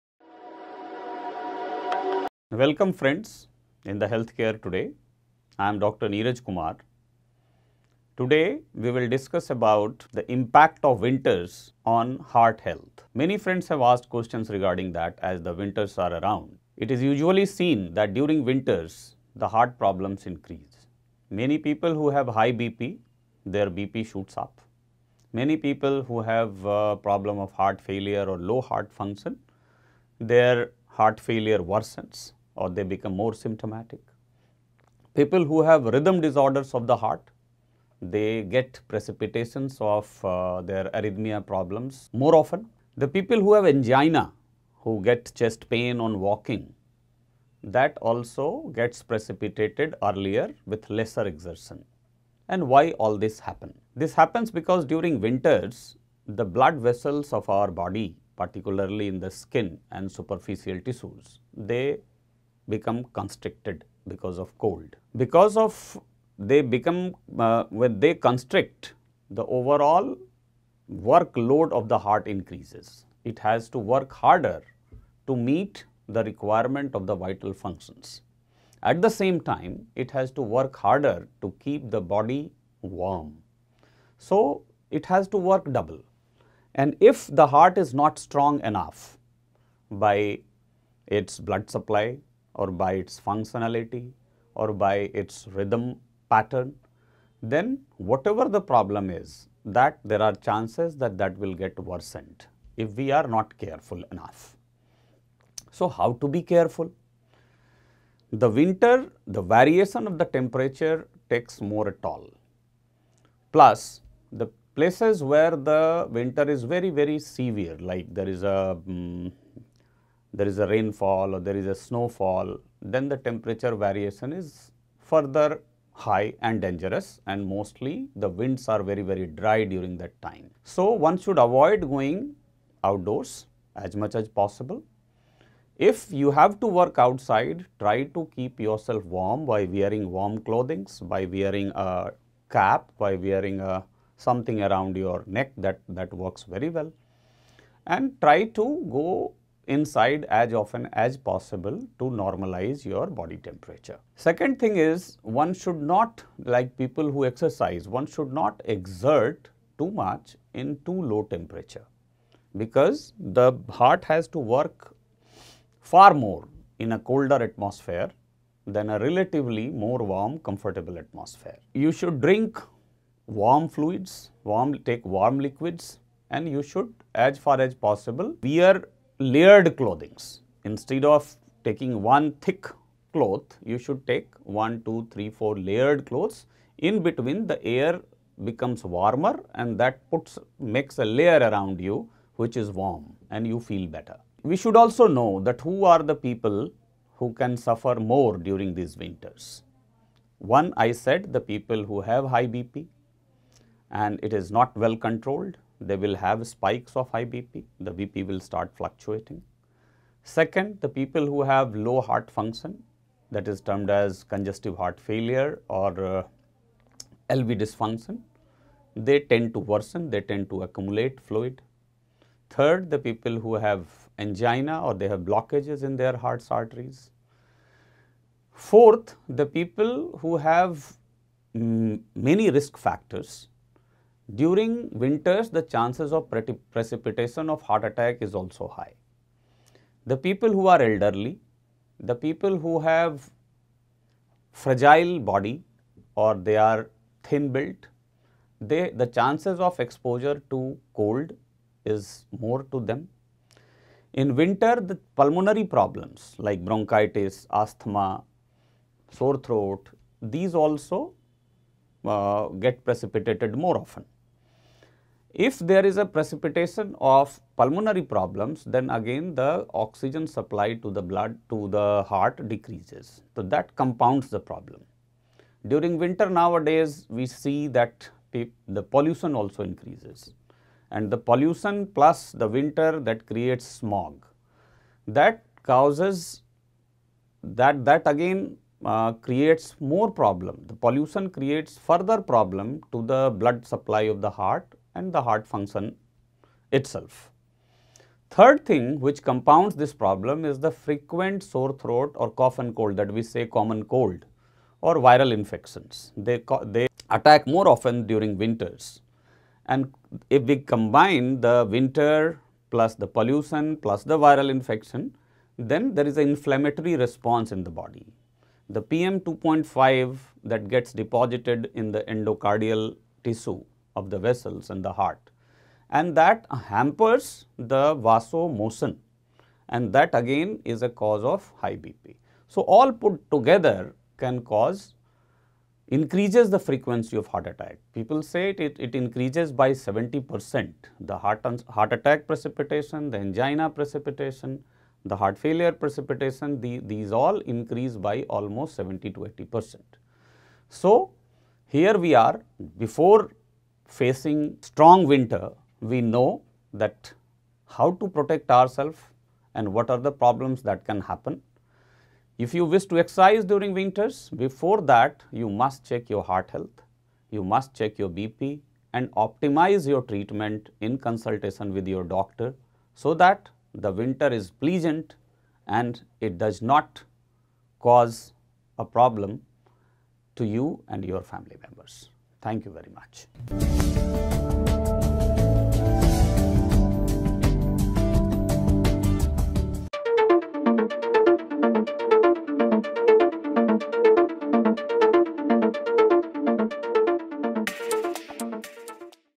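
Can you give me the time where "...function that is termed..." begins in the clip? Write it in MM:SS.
03:32.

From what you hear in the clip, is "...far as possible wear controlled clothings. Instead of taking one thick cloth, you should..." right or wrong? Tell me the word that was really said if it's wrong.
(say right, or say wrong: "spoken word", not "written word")
wrong: "layered", not "controlled".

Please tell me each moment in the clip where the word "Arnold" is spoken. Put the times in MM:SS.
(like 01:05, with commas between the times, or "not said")
not said.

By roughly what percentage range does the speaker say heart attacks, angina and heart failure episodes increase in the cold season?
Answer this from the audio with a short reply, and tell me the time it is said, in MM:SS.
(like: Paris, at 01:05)
70 to 80 percent, at 05:48.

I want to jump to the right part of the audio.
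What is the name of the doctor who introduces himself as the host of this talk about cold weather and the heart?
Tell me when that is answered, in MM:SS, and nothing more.
00:05.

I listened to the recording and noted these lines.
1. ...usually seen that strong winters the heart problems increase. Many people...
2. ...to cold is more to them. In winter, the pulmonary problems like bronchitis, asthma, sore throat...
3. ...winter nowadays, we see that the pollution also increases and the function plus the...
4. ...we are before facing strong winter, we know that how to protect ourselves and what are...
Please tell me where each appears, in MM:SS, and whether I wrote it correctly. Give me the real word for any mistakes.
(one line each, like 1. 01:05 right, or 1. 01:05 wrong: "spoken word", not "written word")
1. 00:17 wrong: "during", not "strong"
2. 04:10 right
3. 04:35 wrong: "pollution", not "function"
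4. 05:51 right.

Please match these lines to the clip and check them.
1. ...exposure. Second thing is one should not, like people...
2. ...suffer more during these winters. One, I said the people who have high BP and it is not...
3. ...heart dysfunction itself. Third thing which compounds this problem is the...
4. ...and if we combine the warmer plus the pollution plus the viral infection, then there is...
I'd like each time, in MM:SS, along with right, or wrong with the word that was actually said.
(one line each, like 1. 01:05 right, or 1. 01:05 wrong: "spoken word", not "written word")
1. 02:33 wrong: "temperature", not "exposure"
2. 03:17 right
3. 04:55 wrong: "function", not "dysfunction"
4. 05:09 wrong: "winter", not "warmer".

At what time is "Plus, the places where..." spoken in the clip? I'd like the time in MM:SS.
01:53.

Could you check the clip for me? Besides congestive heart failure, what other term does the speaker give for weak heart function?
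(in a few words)
LV dysfunction.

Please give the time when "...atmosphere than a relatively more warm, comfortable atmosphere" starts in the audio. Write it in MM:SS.
02:47.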